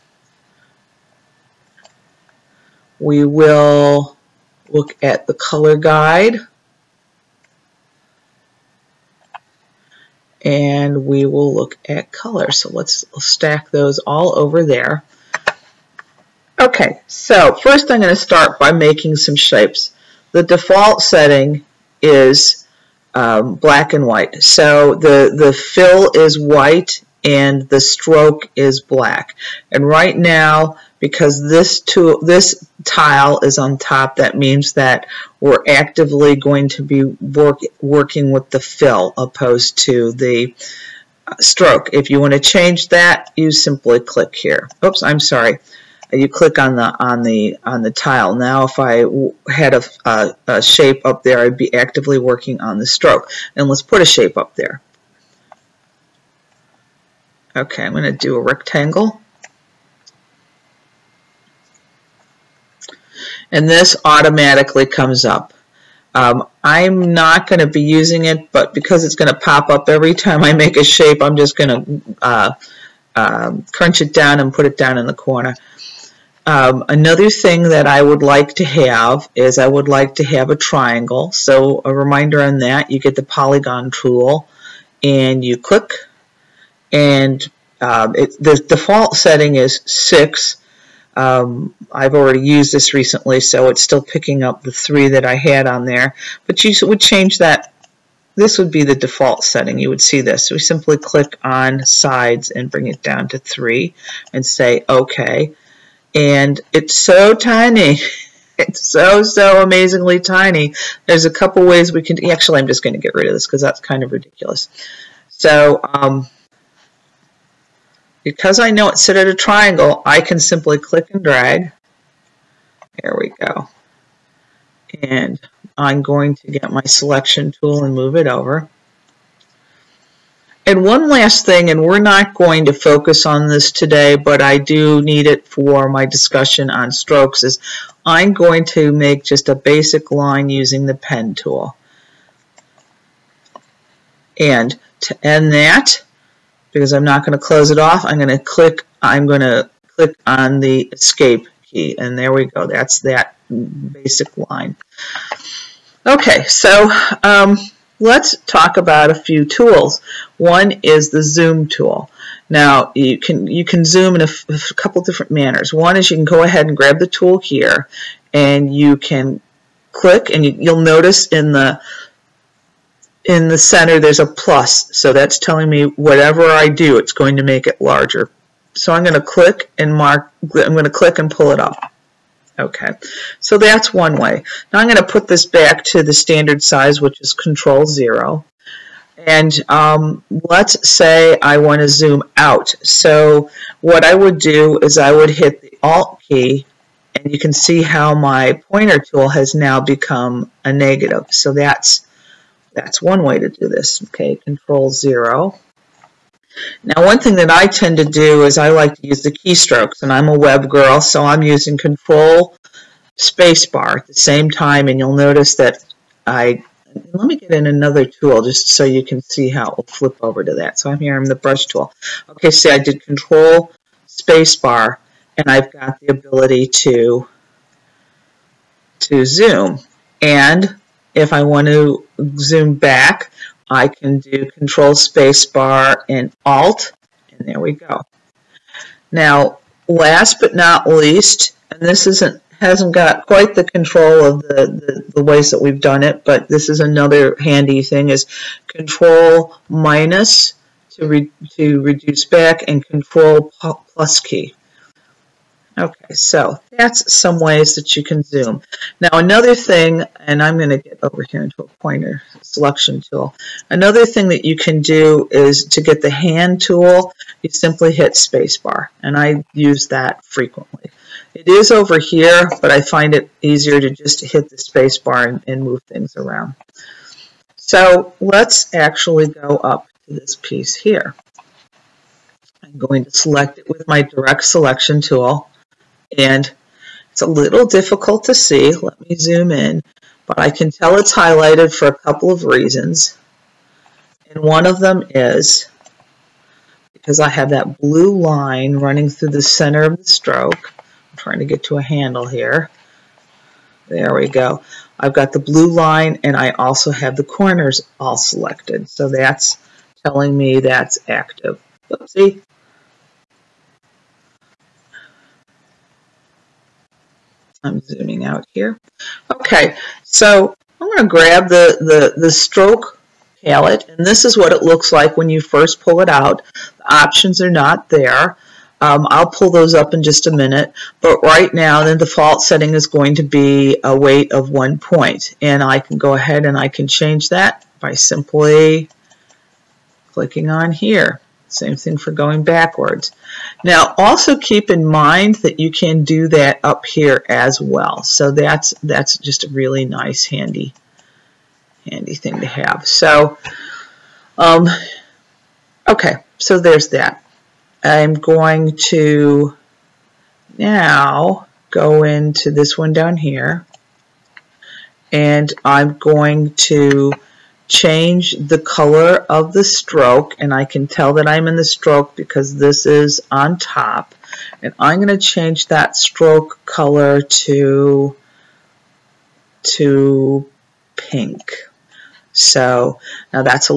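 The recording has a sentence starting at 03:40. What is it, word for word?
So I'm here, I'm the brush tool.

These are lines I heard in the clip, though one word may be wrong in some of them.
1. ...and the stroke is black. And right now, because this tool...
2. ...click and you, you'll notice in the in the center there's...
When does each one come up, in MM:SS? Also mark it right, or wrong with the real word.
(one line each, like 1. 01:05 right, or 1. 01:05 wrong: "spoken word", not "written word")
1. 00:27 right
2. 02:49 right.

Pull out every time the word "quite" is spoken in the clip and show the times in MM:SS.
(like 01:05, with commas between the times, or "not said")
04:03.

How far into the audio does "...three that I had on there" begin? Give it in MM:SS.
01:34.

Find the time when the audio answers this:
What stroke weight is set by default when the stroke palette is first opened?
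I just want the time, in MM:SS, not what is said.
05:34.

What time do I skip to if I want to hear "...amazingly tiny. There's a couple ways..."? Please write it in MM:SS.
01:49.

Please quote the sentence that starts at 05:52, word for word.
So um, okay, so there's that.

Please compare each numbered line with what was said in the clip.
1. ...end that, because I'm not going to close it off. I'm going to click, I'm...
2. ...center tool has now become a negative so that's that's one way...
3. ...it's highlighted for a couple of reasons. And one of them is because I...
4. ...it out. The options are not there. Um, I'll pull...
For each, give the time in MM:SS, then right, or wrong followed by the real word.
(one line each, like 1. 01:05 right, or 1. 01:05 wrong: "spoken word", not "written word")
1. 02:25 right
2. 03:18 wrong: "pointer", not "center"
3. 04:50 right
4. 05:26 right.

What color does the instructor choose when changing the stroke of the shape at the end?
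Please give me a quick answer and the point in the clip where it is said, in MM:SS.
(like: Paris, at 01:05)
Pink, at 06:20.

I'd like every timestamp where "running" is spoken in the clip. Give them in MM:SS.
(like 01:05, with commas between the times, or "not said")
04:58.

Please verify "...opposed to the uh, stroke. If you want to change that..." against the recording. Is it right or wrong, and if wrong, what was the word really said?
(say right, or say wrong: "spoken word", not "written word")
right.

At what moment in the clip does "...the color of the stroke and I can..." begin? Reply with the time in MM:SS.
06:08.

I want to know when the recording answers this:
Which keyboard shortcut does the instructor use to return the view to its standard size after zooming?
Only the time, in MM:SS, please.
03:07.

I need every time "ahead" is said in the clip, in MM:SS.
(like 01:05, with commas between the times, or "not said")
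02:46, 05:36.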